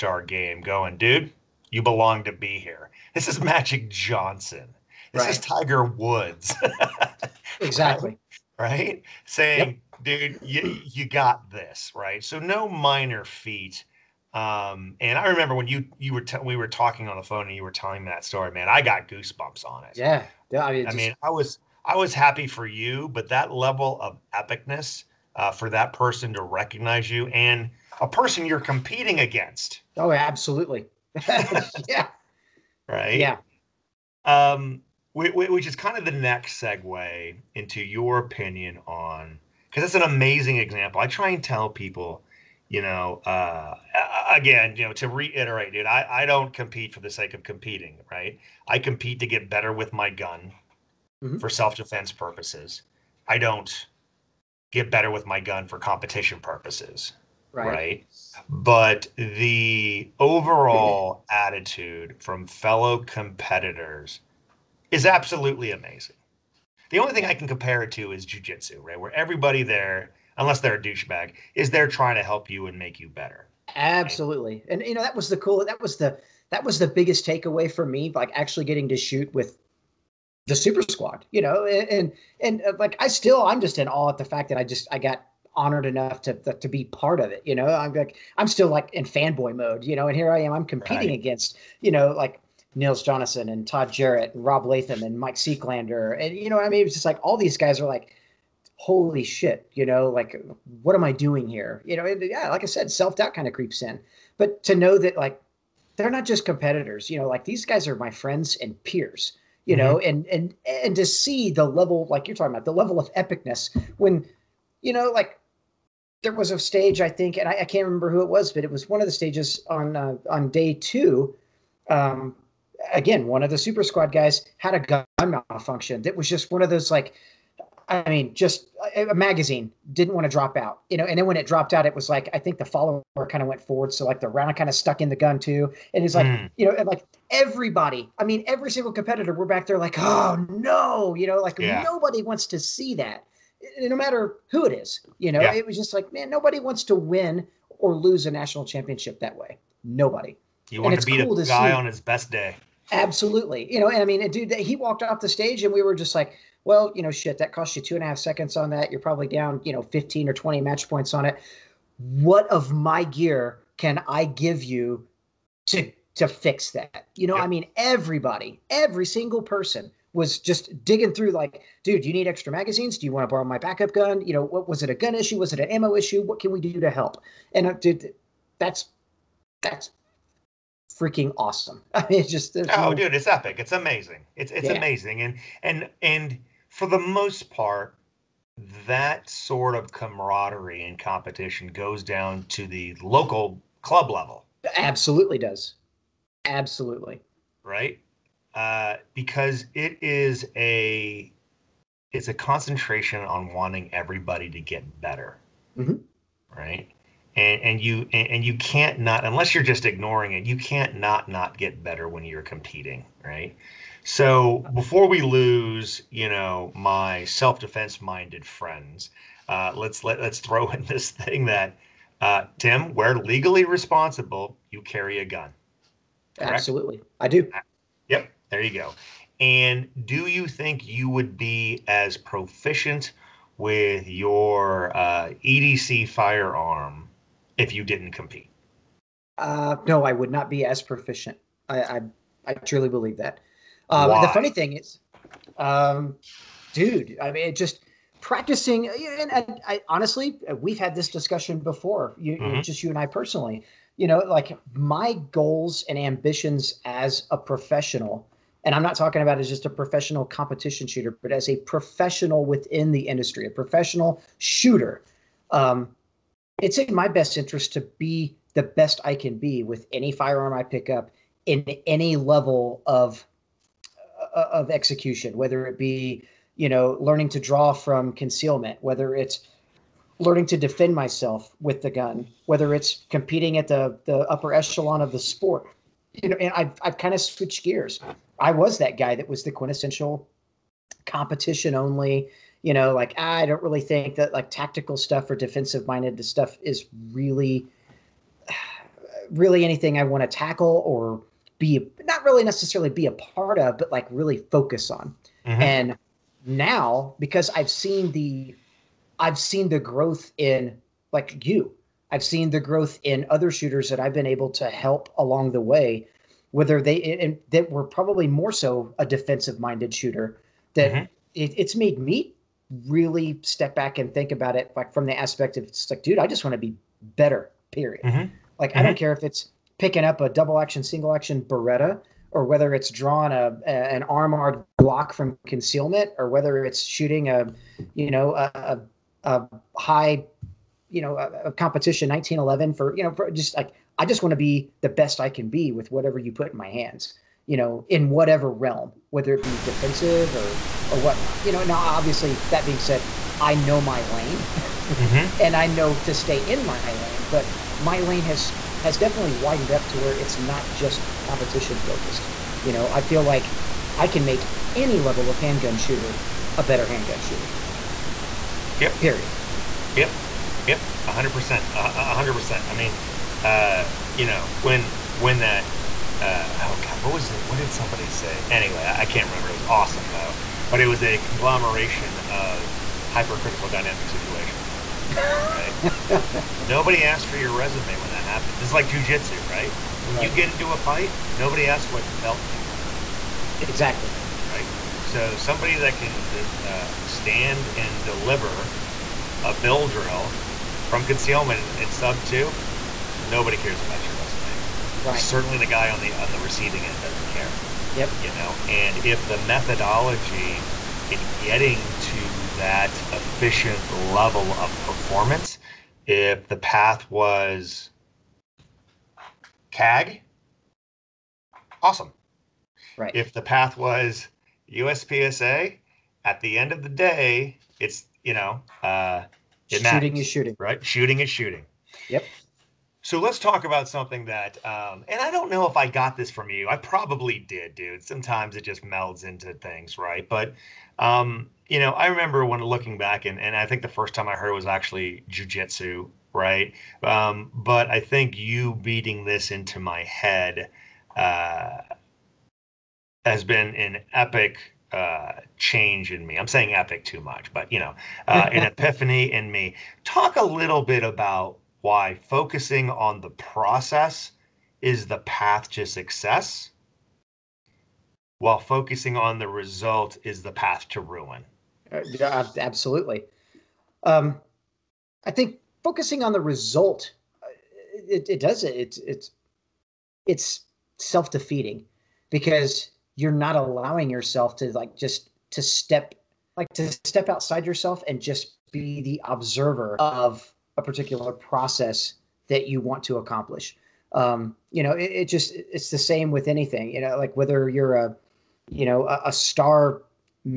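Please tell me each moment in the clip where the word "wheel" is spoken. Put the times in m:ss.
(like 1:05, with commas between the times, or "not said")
not said.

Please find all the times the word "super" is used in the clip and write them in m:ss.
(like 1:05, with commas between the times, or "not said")
1:20, 2:03.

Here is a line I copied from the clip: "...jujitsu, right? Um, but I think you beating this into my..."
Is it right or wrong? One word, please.
right.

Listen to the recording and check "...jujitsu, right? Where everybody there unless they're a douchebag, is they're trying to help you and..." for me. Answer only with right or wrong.
right.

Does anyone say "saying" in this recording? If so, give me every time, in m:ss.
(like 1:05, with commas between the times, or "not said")
0:09, 7:36.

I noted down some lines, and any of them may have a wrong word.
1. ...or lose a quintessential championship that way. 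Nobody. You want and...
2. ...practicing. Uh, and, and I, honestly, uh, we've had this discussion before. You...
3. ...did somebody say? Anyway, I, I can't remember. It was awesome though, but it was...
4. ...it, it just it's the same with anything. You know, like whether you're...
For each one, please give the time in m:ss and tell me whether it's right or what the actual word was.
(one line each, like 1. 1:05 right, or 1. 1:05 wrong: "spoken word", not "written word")
1. 2:27 wrong: "national", not "quintessential"
2. 4:08 right
3. 6:17 right
4. 8:14 right.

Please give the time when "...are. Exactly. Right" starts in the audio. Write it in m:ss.
6:32.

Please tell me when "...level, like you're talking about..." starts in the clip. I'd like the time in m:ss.
1:51.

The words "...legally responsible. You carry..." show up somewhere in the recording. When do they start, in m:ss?
3:43.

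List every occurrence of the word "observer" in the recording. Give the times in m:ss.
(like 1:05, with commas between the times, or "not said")
8:09.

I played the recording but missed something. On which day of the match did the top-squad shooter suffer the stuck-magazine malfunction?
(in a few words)
Day two.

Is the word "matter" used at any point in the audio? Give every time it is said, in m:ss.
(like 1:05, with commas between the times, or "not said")
2:23, 7:09.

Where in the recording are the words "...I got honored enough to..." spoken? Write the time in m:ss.
1:24.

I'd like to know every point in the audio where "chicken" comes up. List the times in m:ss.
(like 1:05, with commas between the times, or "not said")
not said.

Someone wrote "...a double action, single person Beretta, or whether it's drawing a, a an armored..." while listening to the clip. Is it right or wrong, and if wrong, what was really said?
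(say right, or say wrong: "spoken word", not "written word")
wrong: "action", not "person".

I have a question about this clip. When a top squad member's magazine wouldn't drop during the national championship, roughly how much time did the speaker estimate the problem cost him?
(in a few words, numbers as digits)
two and a half seconds.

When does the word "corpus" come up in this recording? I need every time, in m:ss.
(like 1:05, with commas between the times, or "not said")
not said.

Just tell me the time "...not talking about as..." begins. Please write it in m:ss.
4:18.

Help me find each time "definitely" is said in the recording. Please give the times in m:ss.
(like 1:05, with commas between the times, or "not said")
5:58.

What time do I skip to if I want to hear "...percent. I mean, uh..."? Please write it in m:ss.
6:12.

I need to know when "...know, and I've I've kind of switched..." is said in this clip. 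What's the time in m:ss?
4:46.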